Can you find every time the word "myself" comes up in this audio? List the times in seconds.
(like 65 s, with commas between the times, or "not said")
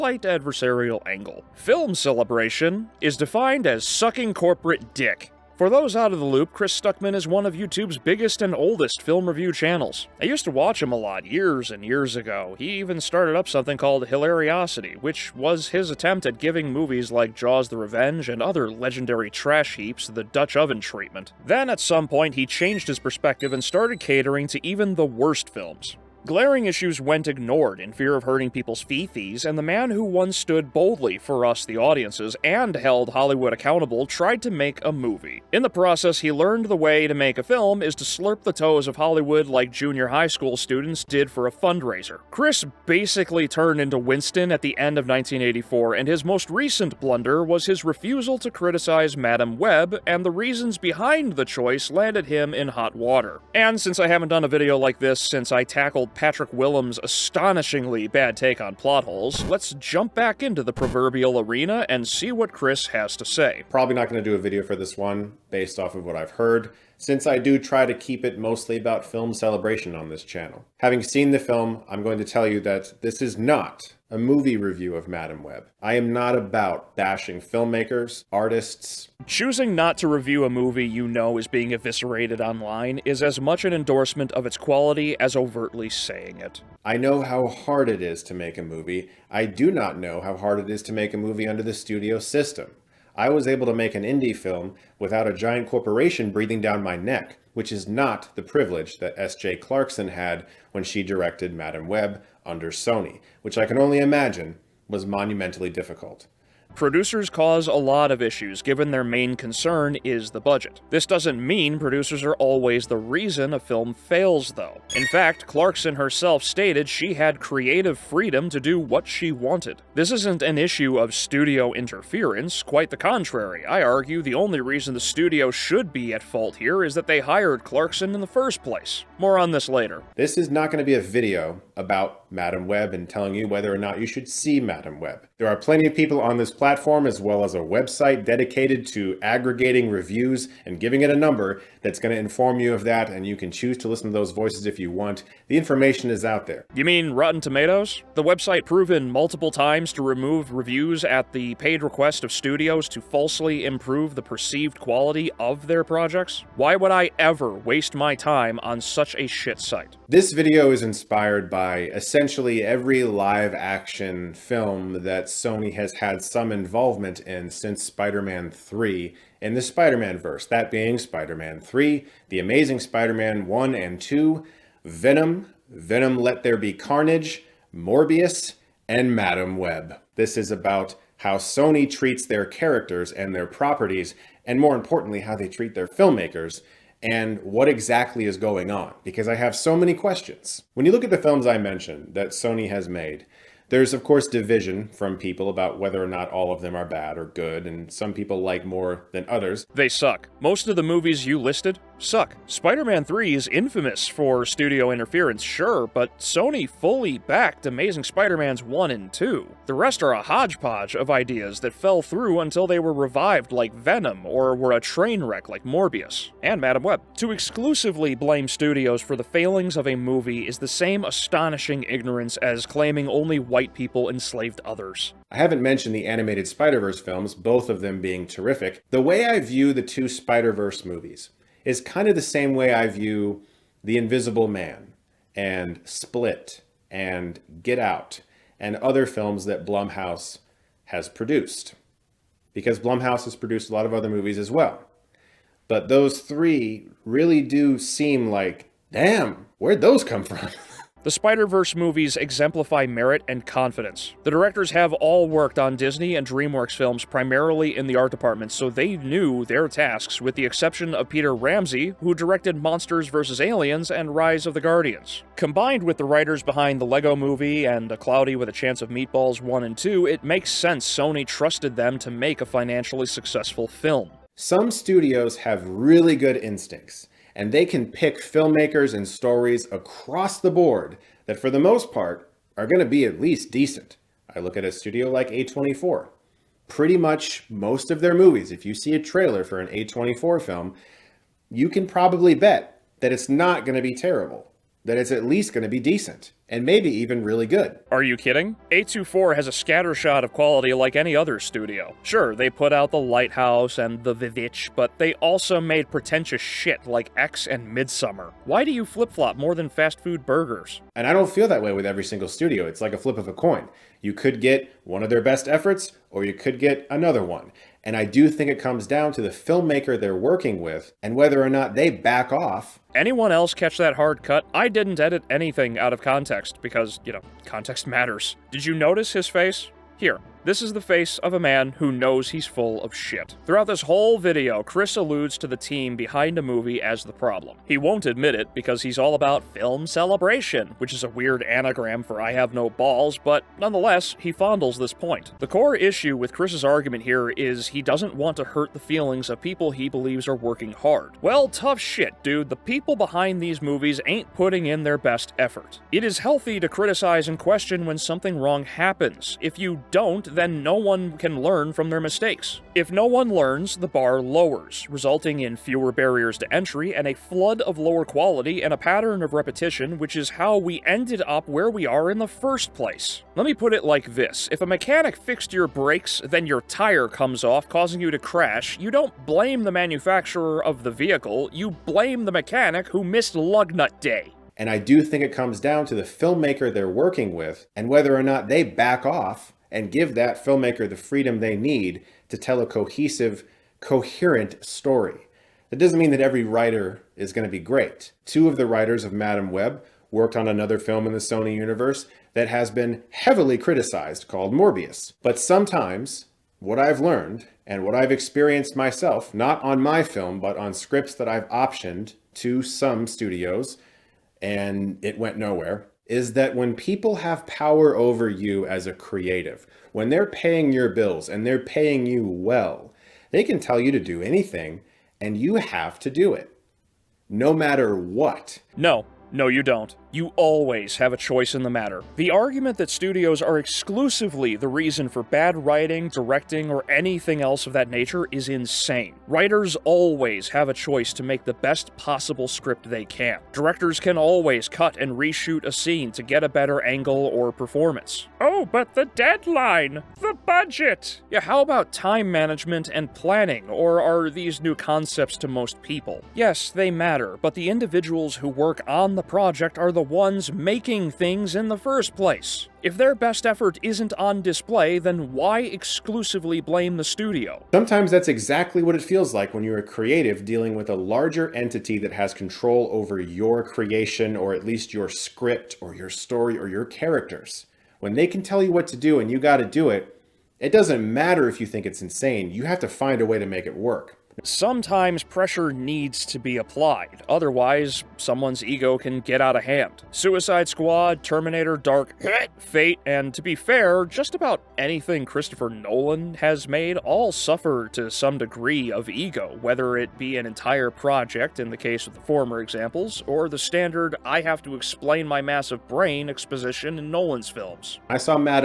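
408 s.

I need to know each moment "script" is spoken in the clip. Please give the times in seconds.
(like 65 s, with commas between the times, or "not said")
410 s, 442 s, 475 s.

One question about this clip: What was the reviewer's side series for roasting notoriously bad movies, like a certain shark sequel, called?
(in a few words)
Hilariocity.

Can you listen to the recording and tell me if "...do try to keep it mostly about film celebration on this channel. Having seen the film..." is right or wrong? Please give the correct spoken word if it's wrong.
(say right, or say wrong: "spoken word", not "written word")
right.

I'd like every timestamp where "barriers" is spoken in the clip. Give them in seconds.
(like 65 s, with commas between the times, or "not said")
365 s.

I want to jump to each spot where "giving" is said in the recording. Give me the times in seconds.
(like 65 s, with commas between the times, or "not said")
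16 s, 140 s.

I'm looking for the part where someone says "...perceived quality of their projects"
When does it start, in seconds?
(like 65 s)
154 s.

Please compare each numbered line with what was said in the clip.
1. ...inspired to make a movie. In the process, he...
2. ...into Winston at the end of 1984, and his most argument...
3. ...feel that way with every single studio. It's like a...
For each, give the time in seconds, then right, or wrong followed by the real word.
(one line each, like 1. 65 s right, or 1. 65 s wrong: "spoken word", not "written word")
1. 34 s wrong: "tried", not "inspired"
2. 43 s wrong: "recent", not "argument"
3. 311 s right.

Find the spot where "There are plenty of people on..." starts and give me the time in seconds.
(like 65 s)
135 s.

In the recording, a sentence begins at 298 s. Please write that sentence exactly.
A24 has a scattershot of quality like any other studio.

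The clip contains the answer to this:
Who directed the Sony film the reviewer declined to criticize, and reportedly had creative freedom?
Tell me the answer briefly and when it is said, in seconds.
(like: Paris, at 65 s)
S.J. Clarkson, at 99 s.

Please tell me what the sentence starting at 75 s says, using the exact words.
I am not about bashing filmmakers, artists.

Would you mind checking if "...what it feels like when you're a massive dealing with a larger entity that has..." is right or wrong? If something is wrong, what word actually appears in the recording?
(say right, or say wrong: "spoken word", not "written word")
wrong: "creative", not "massive".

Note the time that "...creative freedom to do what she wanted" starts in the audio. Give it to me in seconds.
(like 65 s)
117 s.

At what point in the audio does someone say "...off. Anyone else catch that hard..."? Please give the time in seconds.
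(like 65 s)
322 s.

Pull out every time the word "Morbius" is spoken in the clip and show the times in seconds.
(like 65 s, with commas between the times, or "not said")
177 s, 215 s, 404 s.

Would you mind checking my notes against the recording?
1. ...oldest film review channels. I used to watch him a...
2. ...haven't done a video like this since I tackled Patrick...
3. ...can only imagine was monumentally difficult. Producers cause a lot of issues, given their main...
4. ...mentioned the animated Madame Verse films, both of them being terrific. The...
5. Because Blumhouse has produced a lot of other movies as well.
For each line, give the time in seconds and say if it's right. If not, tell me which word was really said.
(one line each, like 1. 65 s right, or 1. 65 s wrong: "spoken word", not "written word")
1. 8 s right
2. 54 s right
3. 103 s right
4. 225 s wrong: "Spider", not "Madame"
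5. 242 s right.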